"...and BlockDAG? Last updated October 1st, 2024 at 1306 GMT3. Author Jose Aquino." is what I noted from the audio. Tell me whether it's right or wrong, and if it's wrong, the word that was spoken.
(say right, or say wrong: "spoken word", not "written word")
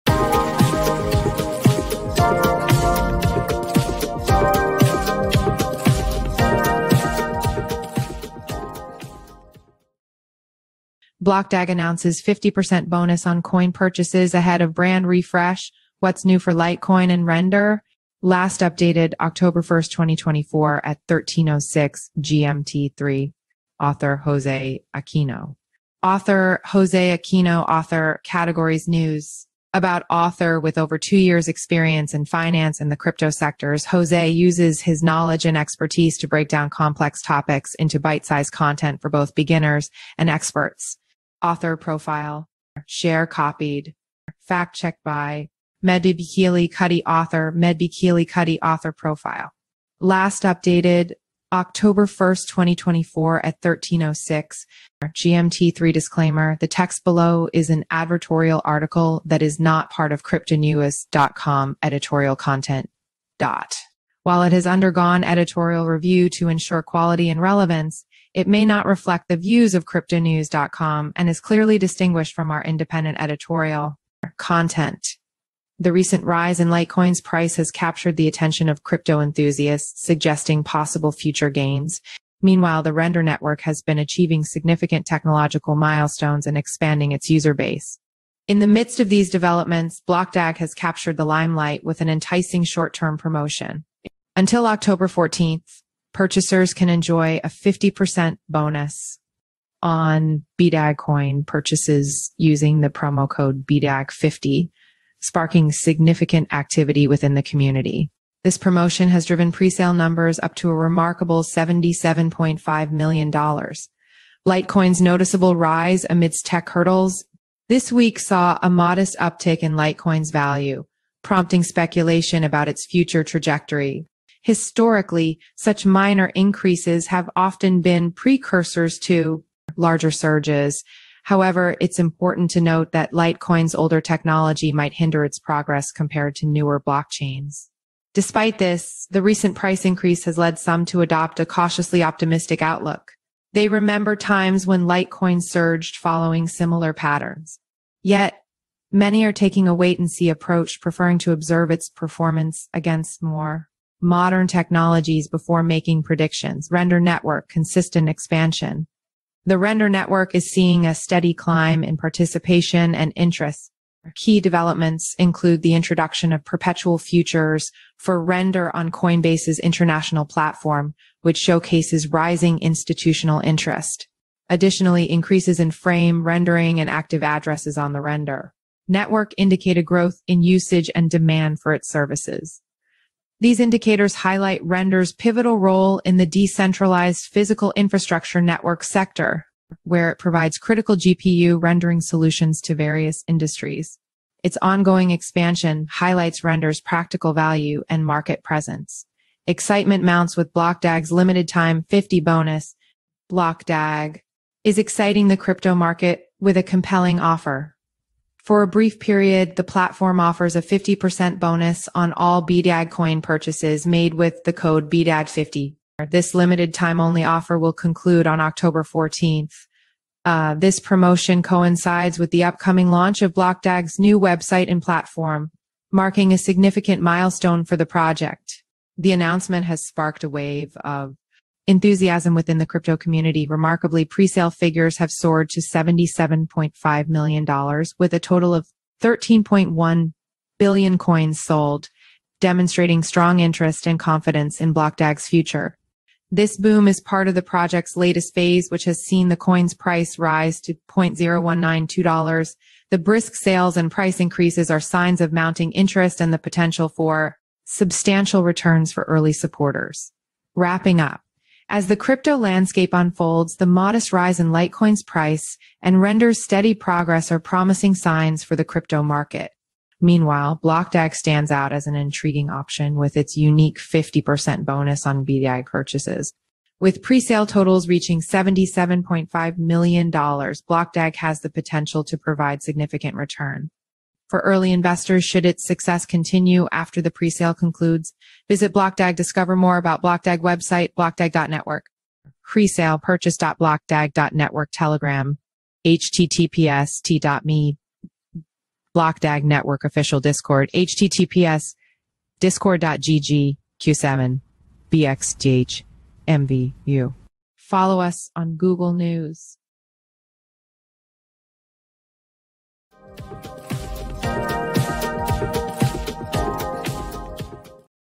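wrong: "Render", not "BlockDAG".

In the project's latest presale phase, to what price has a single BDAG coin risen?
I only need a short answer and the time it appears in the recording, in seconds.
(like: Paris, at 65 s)
$0.0192, at 250 s.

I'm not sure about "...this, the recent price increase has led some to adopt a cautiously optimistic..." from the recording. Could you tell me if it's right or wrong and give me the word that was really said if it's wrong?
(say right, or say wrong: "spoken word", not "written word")
right.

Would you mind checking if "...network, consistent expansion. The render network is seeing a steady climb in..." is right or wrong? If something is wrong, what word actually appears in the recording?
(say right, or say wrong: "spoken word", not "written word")
right.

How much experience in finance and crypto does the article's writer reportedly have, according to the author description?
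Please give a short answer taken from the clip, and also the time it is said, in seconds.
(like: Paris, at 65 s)
over two years, at 30 s.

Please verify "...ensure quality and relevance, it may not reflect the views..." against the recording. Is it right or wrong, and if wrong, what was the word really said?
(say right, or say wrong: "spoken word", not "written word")
right.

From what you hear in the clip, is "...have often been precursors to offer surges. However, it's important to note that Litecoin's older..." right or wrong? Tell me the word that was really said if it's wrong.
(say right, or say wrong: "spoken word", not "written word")
wrong: "larger", not "offer".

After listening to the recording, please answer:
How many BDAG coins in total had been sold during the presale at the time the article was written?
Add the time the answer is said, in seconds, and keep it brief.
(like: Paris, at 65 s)
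13.1 billion, at 239 s.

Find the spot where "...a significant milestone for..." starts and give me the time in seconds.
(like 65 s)
226 s.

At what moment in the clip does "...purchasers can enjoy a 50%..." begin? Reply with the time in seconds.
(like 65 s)
96 s.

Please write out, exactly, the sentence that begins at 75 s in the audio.
The recent rise in Litecoin's price has captured the attention of crypto enthusiasts, suggesting possible future gains.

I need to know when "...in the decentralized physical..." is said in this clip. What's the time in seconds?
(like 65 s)
186 s.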